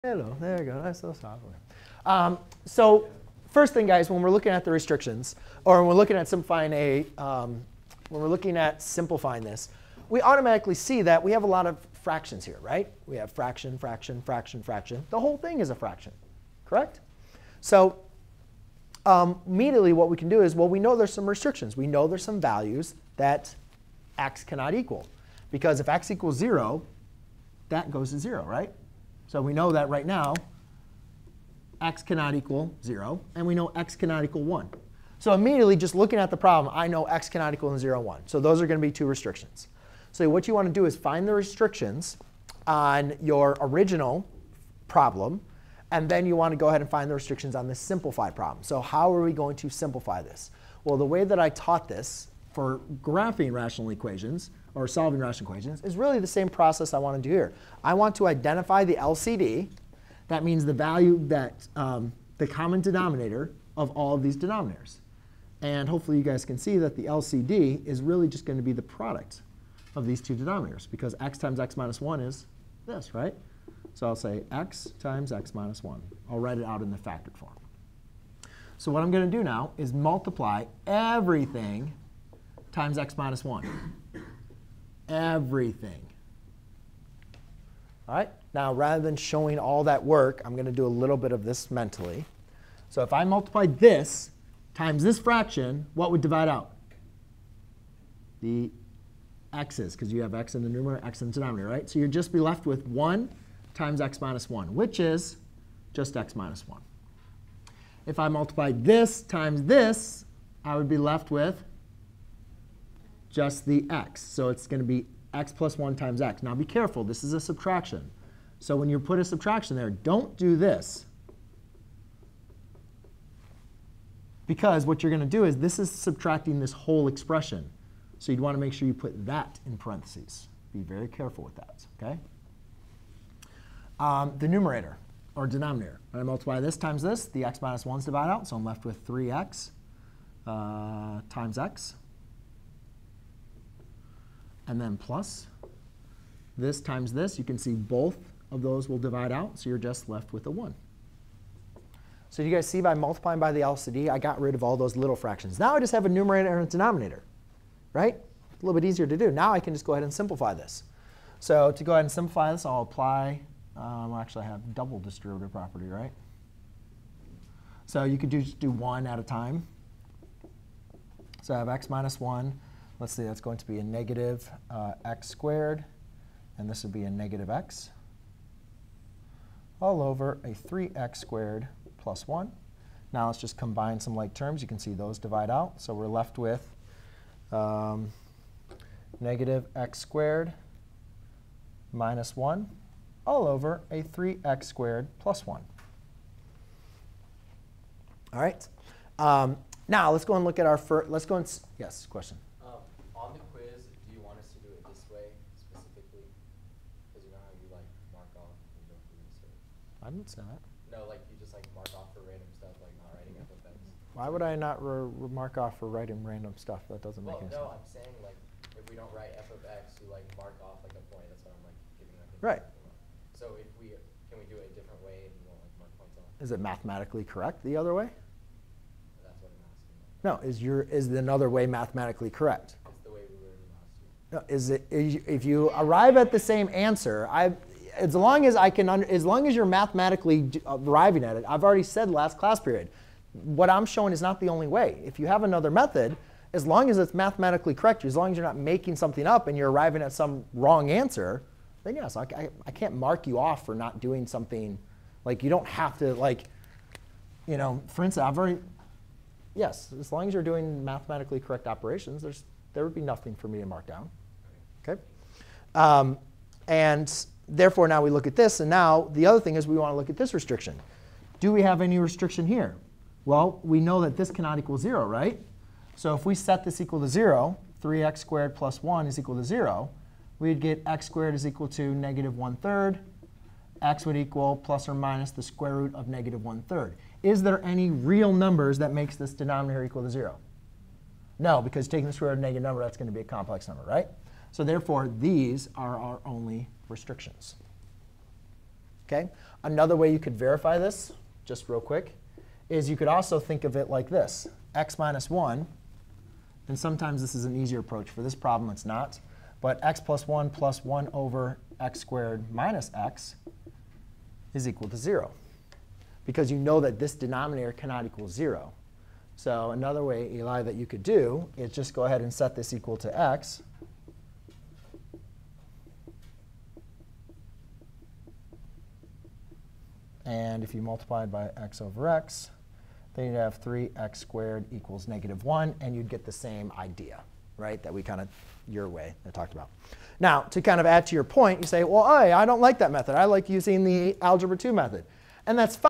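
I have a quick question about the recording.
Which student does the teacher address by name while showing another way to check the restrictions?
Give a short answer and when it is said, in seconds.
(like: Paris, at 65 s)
Eli, at 320 s.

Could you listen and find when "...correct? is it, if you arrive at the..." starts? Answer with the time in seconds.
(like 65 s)
232 s.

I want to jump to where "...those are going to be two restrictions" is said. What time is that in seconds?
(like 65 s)
38 s.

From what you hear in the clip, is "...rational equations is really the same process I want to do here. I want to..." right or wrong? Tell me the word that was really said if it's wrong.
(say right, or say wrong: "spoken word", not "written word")
right.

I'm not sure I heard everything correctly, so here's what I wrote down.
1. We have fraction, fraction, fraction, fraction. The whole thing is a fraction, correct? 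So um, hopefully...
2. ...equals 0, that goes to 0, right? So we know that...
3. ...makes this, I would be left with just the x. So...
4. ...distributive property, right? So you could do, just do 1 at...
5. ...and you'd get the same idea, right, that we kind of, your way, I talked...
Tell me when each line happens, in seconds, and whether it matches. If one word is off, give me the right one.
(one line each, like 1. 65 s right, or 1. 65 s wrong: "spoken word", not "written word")
1. 13 s wrong: "immediately", not "hopefully"
2. 26 s right
3. 109 s wrong: "times", not "makes"
4. 164 s right
5. 335 s right.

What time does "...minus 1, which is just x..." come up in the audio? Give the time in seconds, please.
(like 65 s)
104 s.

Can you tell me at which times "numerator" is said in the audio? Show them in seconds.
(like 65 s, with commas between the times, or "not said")
100 s, 134 s, 156 s.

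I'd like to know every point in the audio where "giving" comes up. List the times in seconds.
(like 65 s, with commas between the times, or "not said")
221 s.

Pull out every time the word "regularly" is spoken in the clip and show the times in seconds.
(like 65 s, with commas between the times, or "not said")
not said.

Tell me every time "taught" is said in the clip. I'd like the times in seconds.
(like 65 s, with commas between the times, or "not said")
51 s.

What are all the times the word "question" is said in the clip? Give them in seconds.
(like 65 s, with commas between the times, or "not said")
202 s.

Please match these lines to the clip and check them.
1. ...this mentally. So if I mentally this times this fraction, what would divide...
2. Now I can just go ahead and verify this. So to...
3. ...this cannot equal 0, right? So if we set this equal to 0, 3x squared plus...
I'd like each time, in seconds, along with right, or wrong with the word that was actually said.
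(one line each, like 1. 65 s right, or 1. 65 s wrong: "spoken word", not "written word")
1. 91 s wrong: "multiply", not "mentally"
2. 159 s wrong: "simplify", not "verify"
3. 274 s right.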